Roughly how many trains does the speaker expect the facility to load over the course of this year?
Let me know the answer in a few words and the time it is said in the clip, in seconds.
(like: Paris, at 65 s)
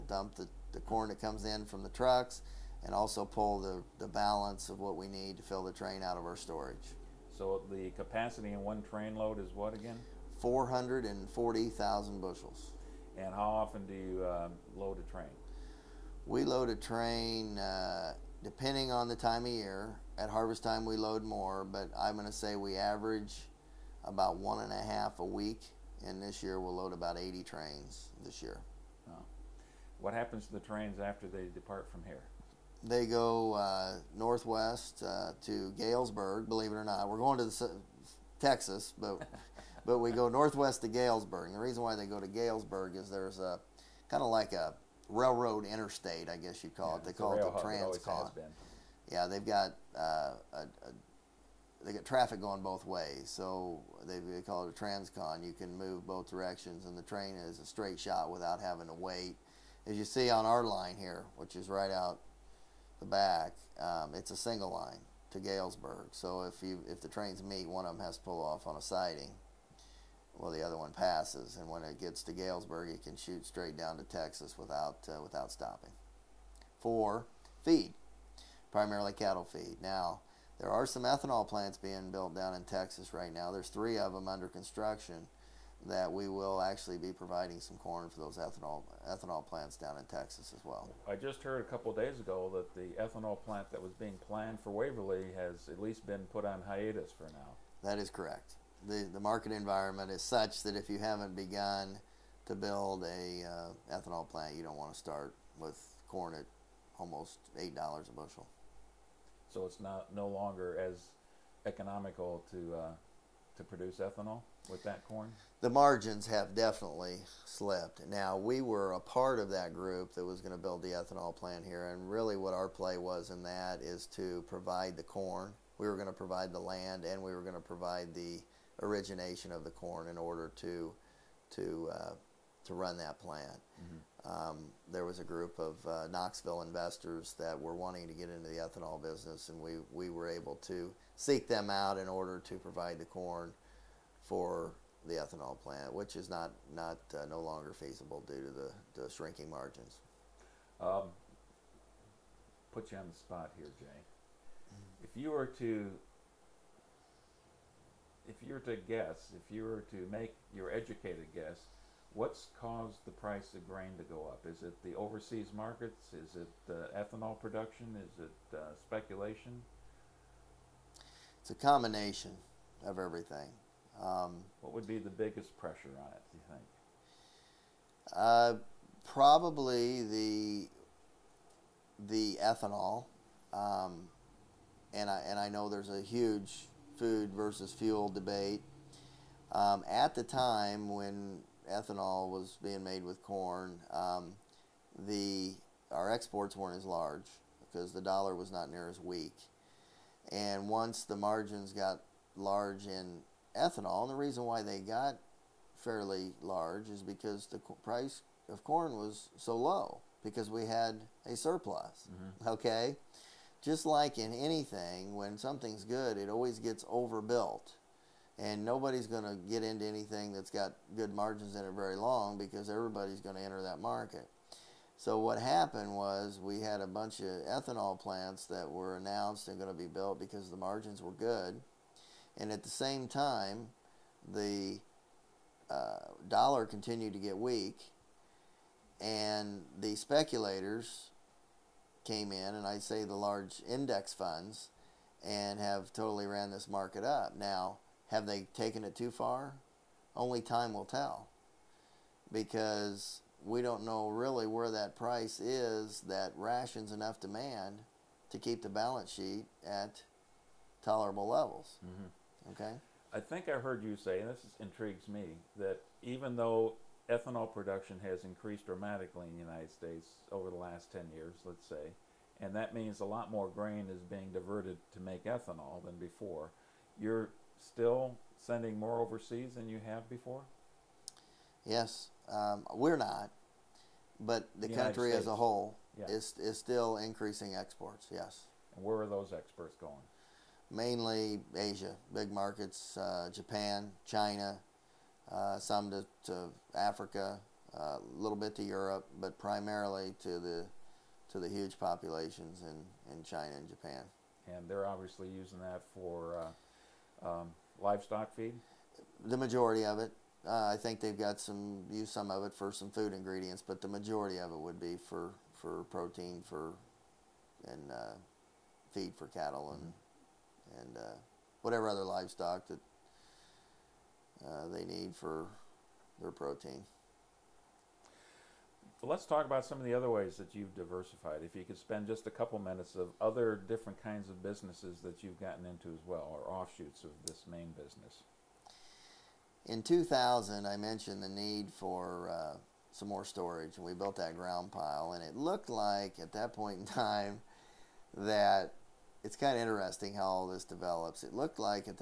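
80, at 27 s.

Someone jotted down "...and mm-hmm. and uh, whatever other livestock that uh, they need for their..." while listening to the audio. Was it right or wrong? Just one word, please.
right.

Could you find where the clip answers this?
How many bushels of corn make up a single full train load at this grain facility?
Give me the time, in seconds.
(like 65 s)
10 s.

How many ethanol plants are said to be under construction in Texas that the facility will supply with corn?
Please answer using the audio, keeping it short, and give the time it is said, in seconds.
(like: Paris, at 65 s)
3, at 83 s.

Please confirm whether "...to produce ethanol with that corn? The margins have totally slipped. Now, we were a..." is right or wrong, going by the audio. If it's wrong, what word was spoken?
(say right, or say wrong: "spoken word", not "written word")
wrong: "definitely", not "totally".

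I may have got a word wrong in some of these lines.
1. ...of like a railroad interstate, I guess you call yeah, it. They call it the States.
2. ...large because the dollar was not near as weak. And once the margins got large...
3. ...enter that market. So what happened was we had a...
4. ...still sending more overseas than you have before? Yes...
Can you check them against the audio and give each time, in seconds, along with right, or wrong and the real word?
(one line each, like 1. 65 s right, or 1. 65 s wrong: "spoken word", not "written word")
1. 44 s wrong: "Transcon", not "States"
2. 196 s right
3. 223 s right
4. 277 s right.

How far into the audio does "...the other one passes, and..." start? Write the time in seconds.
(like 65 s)
70 s.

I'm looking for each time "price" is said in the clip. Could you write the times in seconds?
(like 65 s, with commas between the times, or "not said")
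163 s, 207 s, 254 s.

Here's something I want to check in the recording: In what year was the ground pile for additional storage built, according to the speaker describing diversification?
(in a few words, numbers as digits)
2000.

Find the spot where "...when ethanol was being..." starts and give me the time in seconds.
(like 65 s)
190 s.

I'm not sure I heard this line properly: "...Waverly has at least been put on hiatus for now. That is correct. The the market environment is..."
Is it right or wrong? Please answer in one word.
right.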